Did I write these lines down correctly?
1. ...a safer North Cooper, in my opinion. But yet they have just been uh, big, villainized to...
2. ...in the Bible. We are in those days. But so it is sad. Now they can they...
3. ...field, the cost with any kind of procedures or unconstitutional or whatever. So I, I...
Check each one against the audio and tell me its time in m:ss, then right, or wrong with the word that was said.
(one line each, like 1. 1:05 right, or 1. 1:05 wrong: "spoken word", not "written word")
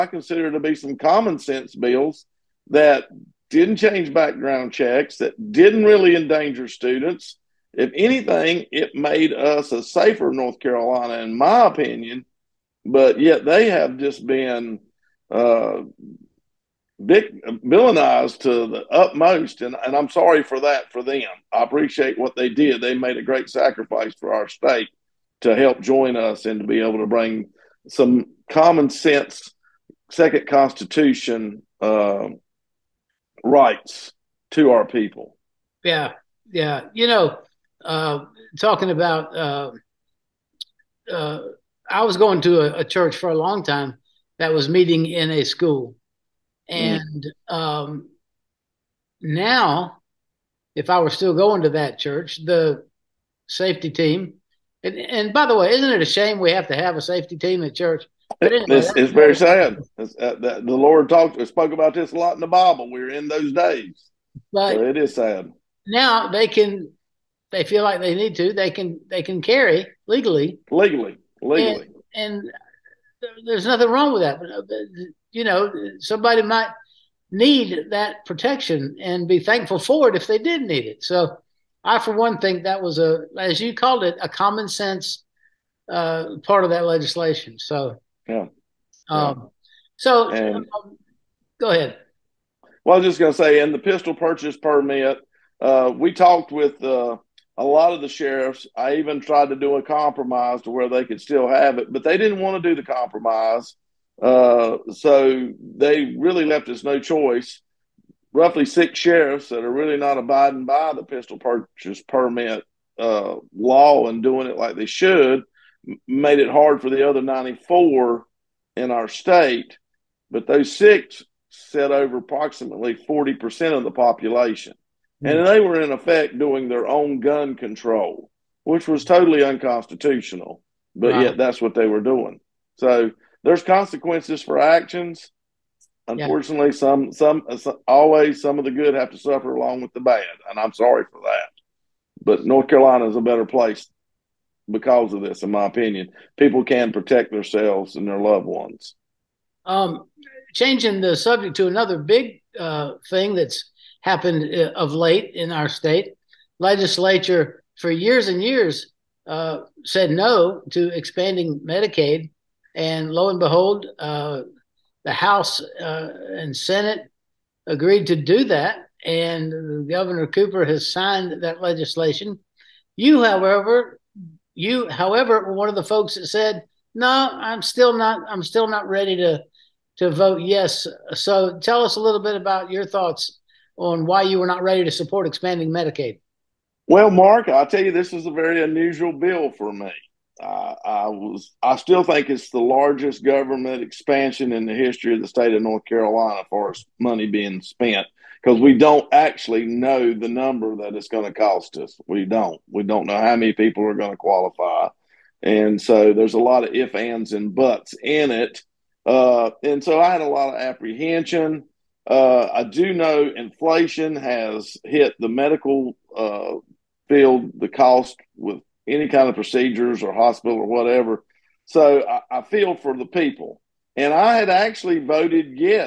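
1. 0:09 wrong: "Carolina", not "Cooper"
2. 1:02 right
3. 3:37 wrong: "hospital", not "unconstitutional".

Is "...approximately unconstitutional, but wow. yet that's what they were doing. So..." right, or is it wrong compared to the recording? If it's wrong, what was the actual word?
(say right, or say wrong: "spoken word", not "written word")
wrong: "totally", not "approximately".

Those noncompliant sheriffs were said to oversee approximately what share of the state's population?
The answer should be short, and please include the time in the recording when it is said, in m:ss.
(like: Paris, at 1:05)
40%, at 2:02.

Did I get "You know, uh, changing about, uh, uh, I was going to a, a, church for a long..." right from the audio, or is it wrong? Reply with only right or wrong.
wrong.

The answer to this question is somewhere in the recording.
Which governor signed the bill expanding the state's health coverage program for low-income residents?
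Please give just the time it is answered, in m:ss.
2:49.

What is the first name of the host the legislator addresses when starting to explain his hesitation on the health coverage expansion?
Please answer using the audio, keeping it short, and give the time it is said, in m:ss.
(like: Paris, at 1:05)
Mark, at 3:07.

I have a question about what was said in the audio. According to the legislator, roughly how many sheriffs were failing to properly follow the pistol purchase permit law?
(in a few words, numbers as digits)
6.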